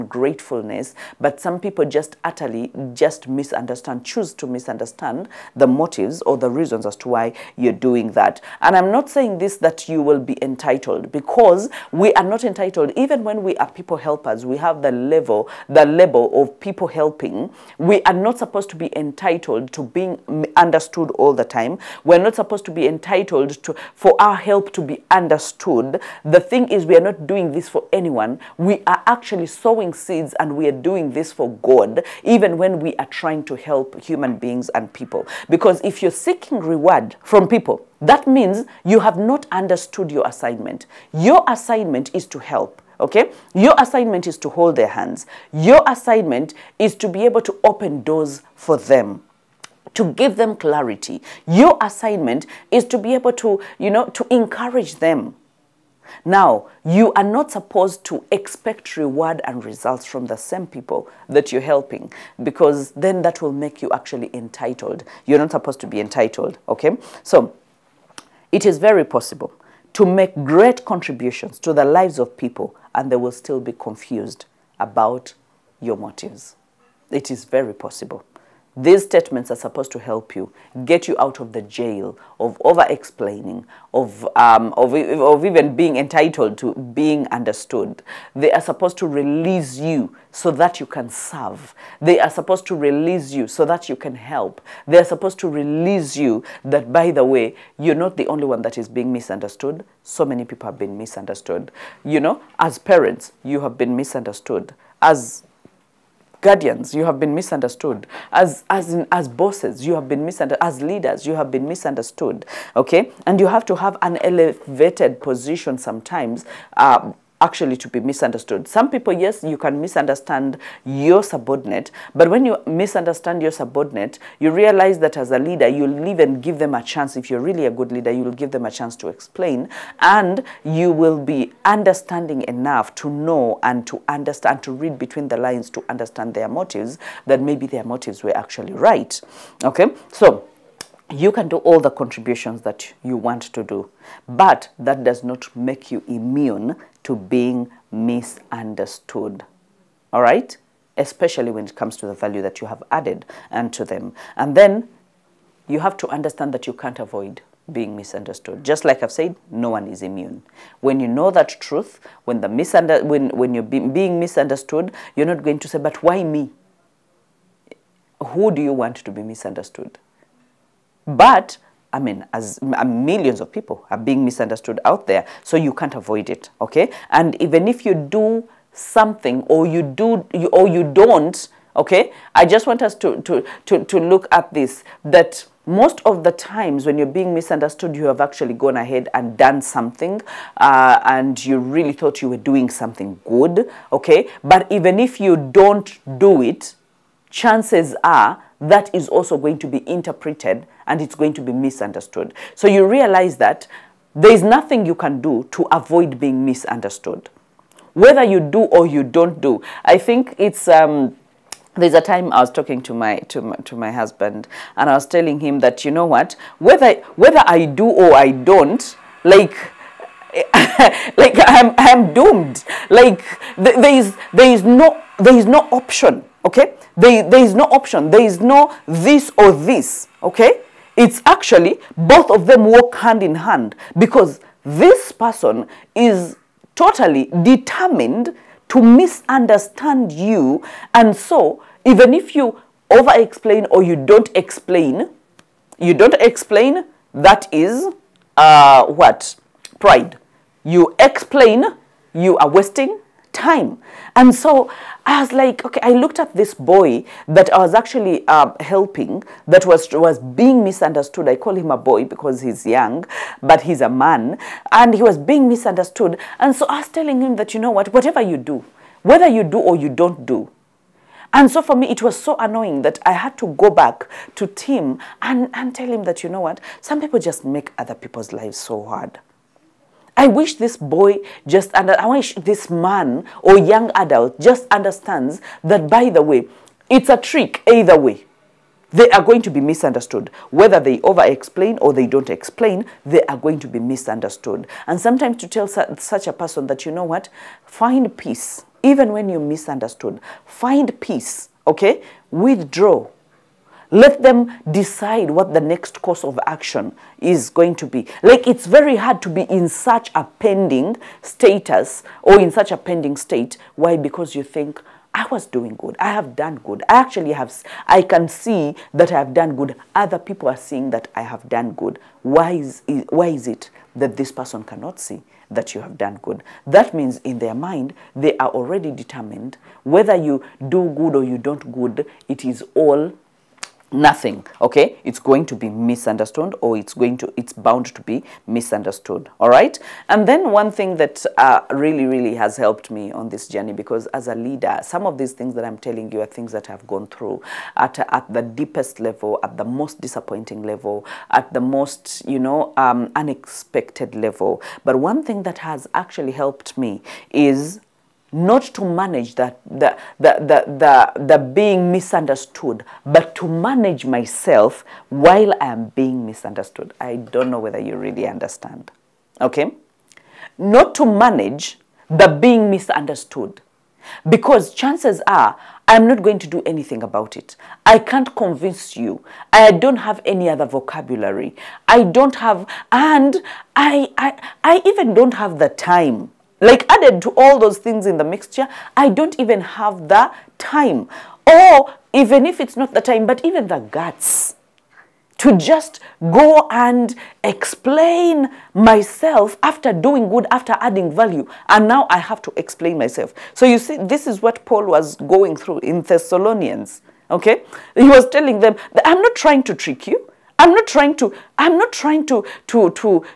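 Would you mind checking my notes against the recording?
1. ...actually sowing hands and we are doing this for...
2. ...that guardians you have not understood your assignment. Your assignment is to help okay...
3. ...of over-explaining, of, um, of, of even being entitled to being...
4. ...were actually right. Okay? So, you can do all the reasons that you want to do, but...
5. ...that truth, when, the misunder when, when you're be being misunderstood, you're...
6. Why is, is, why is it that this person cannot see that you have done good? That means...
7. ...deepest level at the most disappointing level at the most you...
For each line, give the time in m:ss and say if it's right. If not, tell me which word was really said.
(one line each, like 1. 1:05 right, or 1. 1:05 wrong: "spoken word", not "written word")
1. 0:29 wrong: "seeds", not "hands"
2. 0:38 wrong: "means", not "guardians"
3. 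1:22 right
4. 2:18 wrong: "contributions", not "reasons"
5. 2:41 right
6. 5:22 right
7. 5:48 right.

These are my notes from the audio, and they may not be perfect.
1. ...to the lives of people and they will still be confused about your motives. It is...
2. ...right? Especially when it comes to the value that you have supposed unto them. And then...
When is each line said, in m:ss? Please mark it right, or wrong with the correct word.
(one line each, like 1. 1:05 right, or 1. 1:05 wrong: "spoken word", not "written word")
1. 1:11 right
2. 2:30 wrong: "added", not "supposed".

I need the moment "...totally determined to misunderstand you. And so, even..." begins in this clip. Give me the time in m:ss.
3:56.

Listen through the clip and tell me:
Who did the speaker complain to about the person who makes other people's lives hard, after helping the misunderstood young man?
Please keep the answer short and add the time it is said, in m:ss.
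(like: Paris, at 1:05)
Tim, at 4:34.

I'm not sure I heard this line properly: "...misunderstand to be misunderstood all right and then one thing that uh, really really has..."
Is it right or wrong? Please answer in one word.
wrong.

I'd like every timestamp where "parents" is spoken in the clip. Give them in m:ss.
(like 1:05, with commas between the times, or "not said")
1:42.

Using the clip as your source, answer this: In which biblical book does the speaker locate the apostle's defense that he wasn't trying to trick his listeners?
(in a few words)
Thessalonians.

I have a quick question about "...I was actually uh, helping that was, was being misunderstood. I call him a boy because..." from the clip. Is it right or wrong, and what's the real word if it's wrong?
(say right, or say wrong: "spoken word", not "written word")
right.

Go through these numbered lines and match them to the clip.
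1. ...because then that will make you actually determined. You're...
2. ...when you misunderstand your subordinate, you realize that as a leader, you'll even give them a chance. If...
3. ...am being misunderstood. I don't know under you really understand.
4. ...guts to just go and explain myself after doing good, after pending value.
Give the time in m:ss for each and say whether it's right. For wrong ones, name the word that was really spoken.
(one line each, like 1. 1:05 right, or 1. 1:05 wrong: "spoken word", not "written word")
1. 1:02 wrong: "entitled", not "determined"
2. 2:02 right
3. 6:05 wrong: "whether", not "under"
4. 6:33 wrong: "adding", not "pending".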